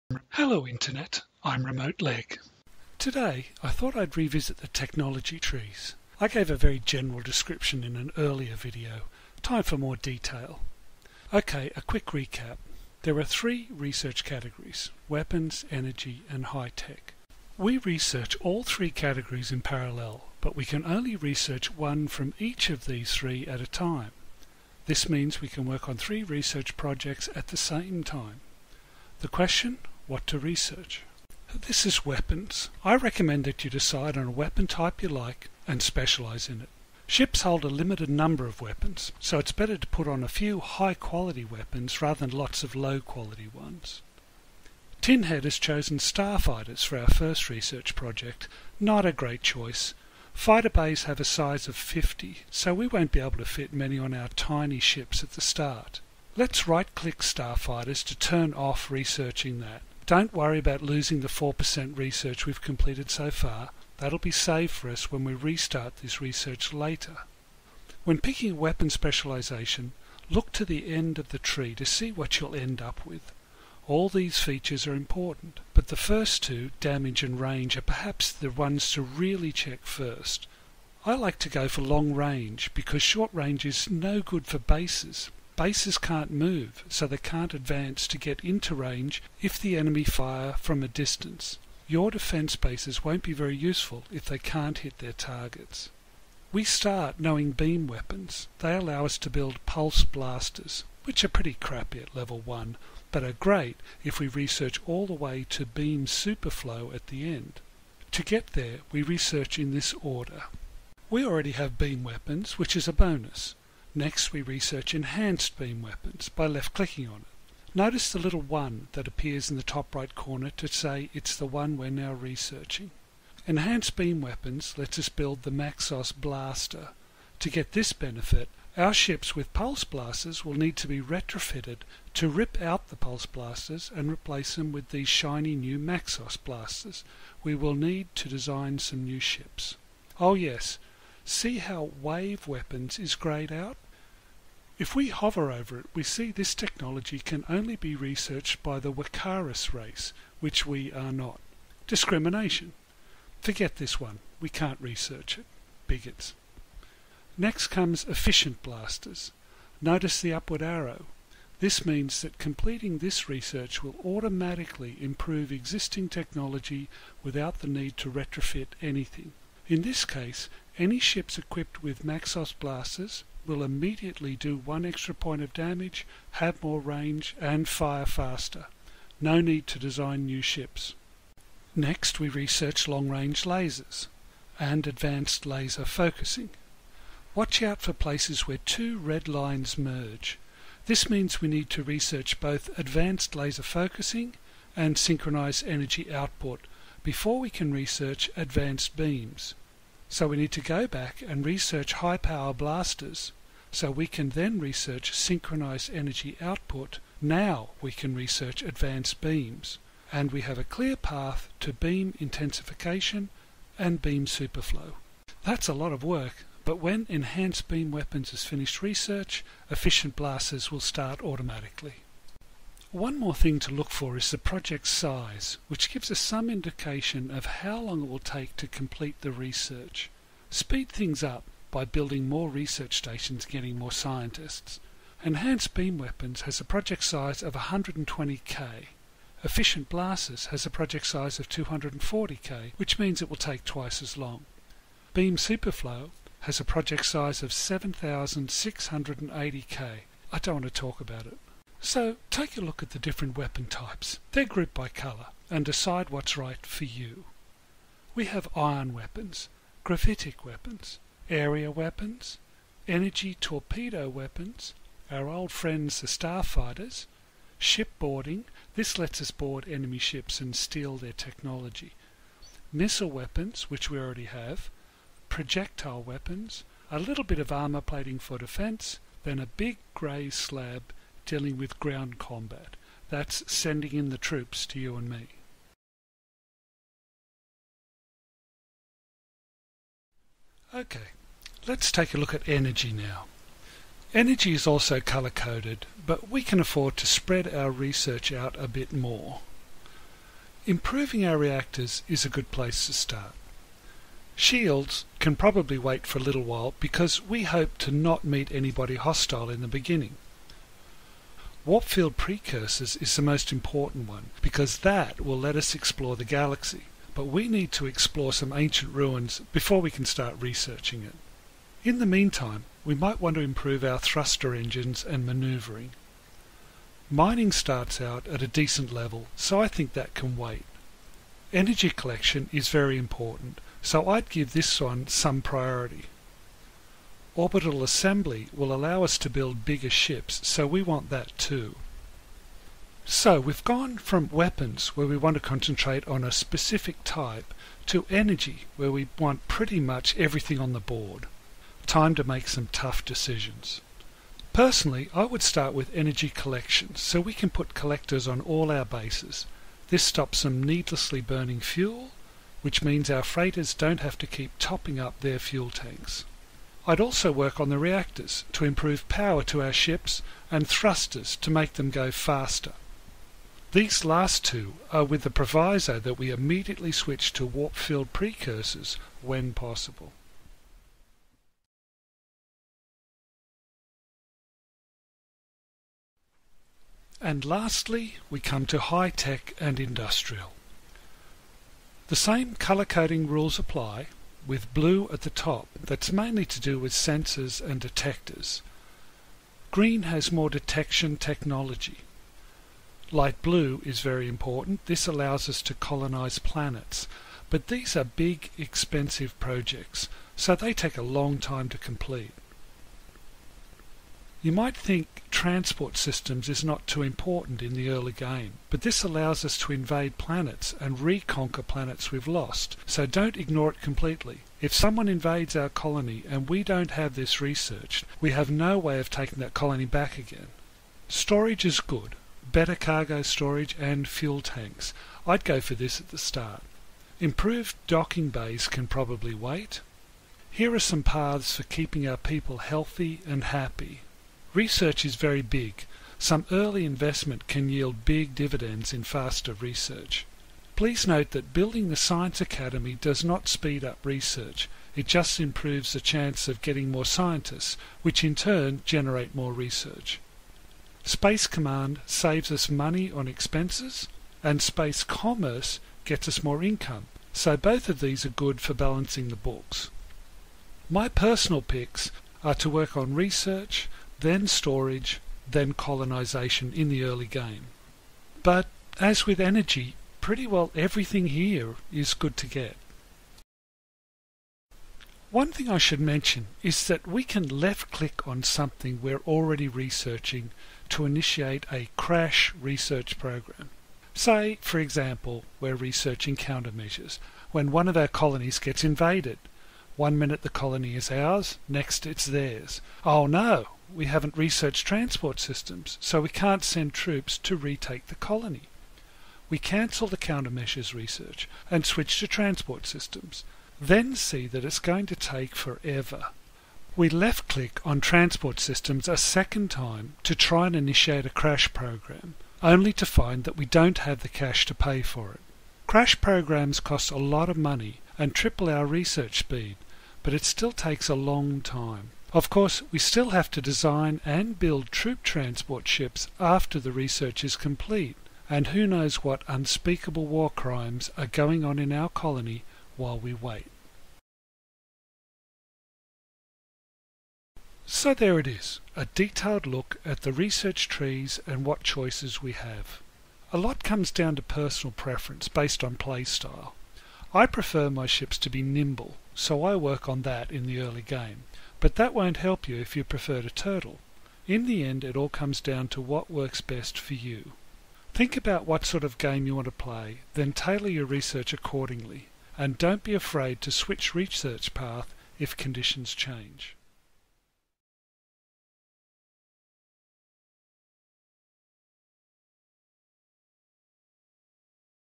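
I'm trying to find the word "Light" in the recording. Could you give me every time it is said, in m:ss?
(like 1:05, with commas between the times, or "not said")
6:43.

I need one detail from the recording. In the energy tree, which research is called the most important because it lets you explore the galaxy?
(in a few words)
Warp field precursors.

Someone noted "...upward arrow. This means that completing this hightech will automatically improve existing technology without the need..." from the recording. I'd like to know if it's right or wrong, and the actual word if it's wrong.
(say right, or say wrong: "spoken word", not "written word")
wrong: "research", not "hightech".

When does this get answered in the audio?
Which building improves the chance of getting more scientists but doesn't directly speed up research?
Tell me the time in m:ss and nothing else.
7:31.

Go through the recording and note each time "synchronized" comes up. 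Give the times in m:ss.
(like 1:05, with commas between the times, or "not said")
3:14, 3:25.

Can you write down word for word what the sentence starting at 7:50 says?
My personal picks are to work on research, then storage, then colonization in the early game.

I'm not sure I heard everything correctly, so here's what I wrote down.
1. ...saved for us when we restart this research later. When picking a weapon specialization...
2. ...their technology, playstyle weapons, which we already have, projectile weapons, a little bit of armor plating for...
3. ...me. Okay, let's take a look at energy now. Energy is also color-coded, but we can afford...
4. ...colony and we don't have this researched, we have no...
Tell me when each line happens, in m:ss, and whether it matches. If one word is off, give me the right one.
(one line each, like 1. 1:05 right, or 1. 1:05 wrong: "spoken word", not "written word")
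1. 1:04 right
2. 4:30 wrong: "missile", not "playstyle"
3. 4:45 right
4. 7:05 right.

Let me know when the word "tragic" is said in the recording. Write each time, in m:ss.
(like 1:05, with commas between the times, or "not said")
not said.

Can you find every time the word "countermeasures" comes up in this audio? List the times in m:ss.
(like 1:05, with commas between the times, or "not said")
8:16, 8:30.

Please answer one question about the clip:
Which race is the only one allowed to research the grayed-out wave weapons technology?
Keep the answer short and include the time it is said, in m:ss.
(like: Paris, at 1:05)
Wekkarus, at 2:28.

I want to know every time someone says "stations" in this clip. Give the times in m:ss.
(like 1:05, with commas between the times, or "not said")
3:52.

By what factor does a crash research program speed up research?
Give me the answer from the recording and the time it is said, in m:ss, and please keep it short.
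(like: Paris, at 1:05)
3 (triple), at 8:48.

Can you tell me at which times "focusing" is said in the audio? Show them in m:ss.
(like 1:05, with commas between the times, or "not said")
3:05, 3:13.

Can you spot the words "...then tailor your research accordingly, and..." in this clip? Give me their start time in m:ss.
9:30.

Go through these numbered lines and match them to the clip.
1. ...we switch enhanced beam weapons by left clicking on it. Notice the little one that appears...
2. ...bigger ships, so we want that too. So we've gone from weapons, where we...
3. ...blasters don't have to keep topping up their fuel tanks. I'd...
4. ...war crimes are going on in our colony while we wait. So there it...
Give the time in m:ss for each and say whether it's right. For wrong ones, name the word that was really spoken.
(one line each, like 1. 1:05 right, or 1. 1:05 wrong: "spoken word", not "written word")
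1. 1:54 wrong: "research", not "switch"
2. 5:39 right
3. 6:03 wrong: "freighters", not "blasters"
4. 9:00 right.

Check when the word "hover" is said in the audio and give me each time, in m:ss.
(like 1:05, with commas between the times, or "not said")
2:25.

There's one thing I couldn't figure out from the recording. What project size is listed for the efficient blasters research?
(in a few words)
240k.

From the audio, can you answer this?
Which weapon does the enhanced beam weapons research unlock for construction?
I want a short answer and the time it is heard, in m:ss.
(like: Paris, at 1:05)
Maxos blaster, at 2:05.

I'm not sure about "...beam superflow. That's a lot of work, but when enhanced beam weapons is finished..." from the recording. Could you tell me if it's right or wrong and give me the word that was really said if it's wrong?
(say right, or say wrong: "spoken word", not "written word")
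right.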